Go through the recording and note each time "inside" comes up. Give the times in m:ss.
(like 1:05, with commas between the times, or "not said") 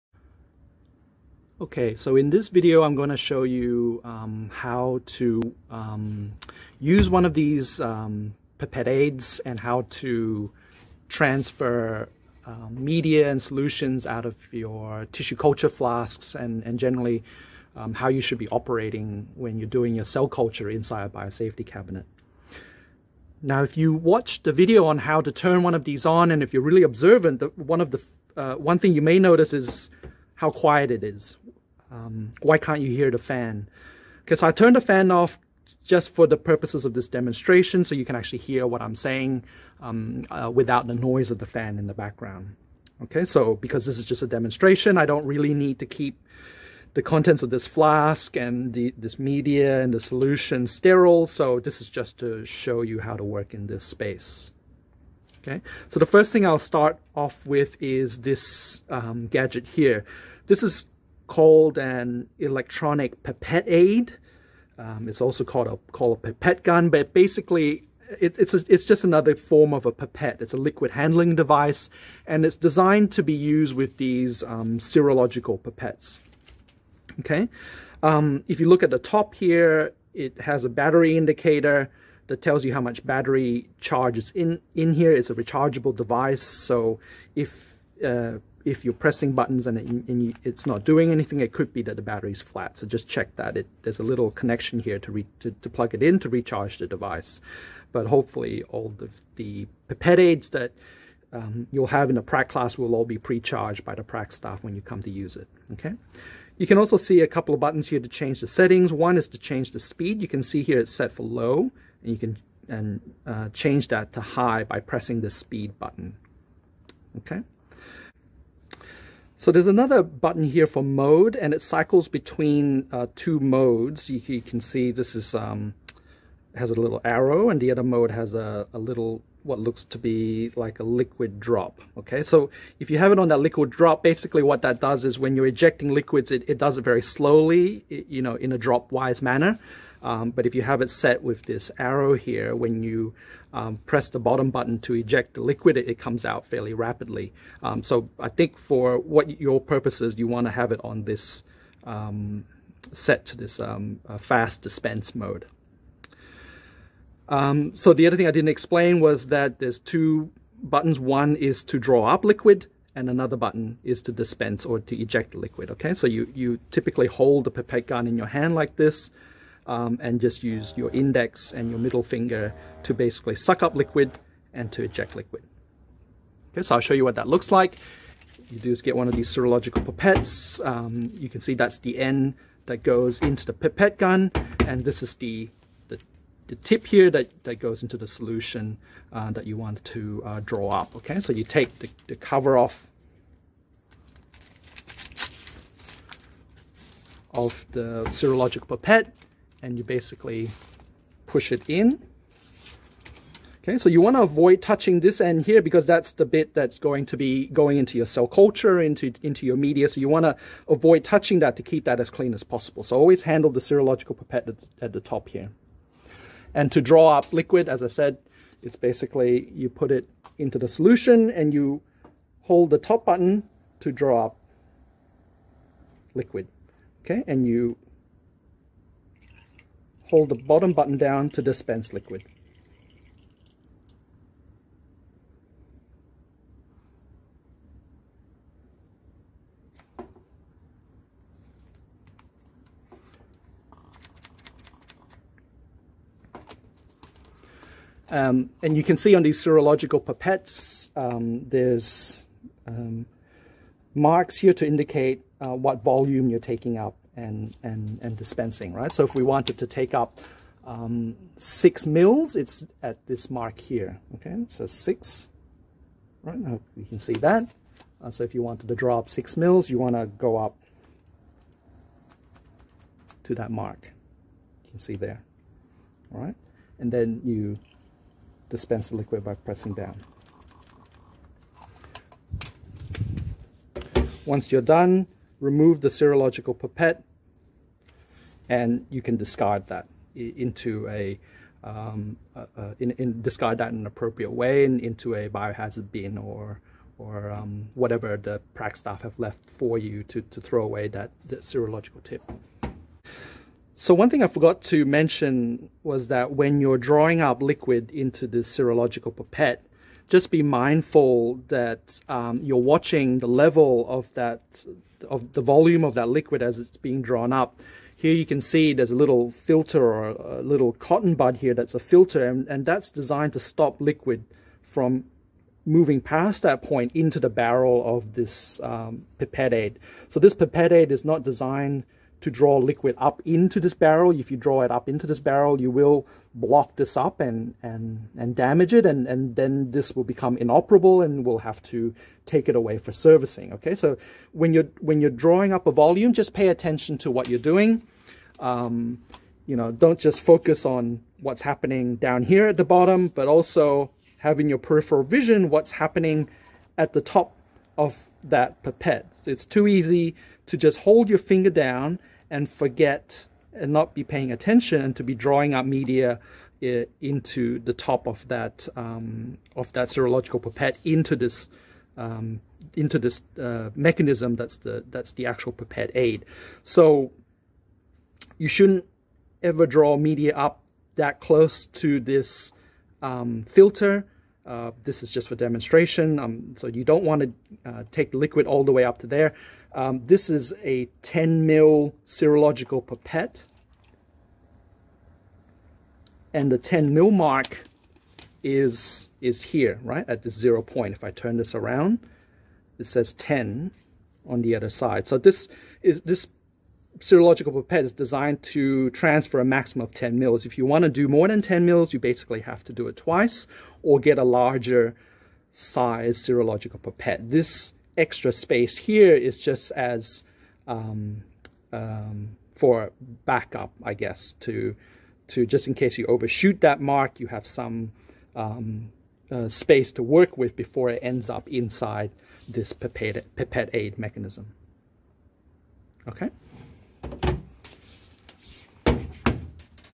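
0:20, 7:11.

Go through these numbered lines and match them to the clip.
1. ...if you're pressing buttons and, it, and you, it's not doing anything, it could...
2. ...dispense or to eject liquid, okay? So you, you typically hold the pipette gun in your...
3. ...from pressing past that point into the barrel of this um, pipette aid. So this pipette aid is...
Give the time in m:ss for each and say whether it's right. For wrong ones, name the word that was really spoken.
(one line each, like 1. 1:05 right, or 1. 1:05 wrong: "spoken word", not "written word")
1. 1:28 right
2. 2:44 right
3. 5:24 wrong: "moving", not "pressing".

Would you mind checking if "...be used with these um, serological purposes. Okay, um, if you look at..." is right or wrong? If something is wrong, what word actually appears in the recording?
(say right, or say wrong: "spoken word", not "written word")
wrong: "pipettes", not "purposes".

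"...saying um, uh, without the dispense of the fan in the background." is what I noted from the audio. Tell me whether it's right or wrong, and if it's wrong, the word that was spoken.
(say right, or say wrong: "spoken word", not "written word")
wrong: "noise", not "dispense".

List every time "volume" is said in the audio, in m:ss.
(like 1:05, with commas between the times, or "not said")
4:15, 5:15, 5:45.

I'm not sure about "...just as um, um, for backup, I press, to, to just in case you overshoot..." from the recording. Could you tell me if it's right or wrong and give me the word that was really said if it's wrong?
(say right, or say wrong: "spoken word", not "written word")
wrong: "guess", not "press".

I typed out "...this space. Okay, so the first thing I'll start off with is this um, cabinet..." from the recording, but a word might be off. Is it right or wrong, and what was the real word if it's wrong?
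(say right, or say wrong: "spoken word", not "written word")
wrong: "gadget", not "cabinet".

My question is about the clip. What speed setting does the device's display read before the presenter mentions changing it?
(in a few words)
low.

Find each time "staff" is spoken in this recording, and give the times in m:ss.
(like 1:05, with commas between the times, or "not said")
1:44, 4:58.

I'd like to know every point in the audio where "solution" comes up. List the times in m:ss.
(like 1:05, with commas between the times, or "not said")
0:13, 0:49, 3:08, 3:40.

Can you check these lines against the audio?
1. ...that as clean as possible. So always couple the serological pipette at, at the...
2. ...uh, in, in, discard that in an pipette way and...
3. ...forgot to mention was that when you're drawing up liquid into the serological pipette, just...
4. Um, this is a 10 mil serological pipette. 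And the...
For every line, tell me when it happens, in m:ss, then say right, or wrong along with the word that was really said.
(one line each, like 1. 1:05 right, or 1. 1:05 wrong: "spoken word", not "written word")
1. 3:31 wrong: "handle", not "couple"
2. 4:52 wrong: "appropriate", not "pipette"
3. 5:04 right
4. 6:29 right.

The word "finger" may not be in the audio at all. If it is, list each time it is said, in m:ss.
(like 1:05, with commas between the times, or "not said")
2:52, 6:01.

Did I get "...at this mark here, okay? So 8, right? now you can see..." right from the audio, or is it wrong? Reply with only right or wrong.
wrong.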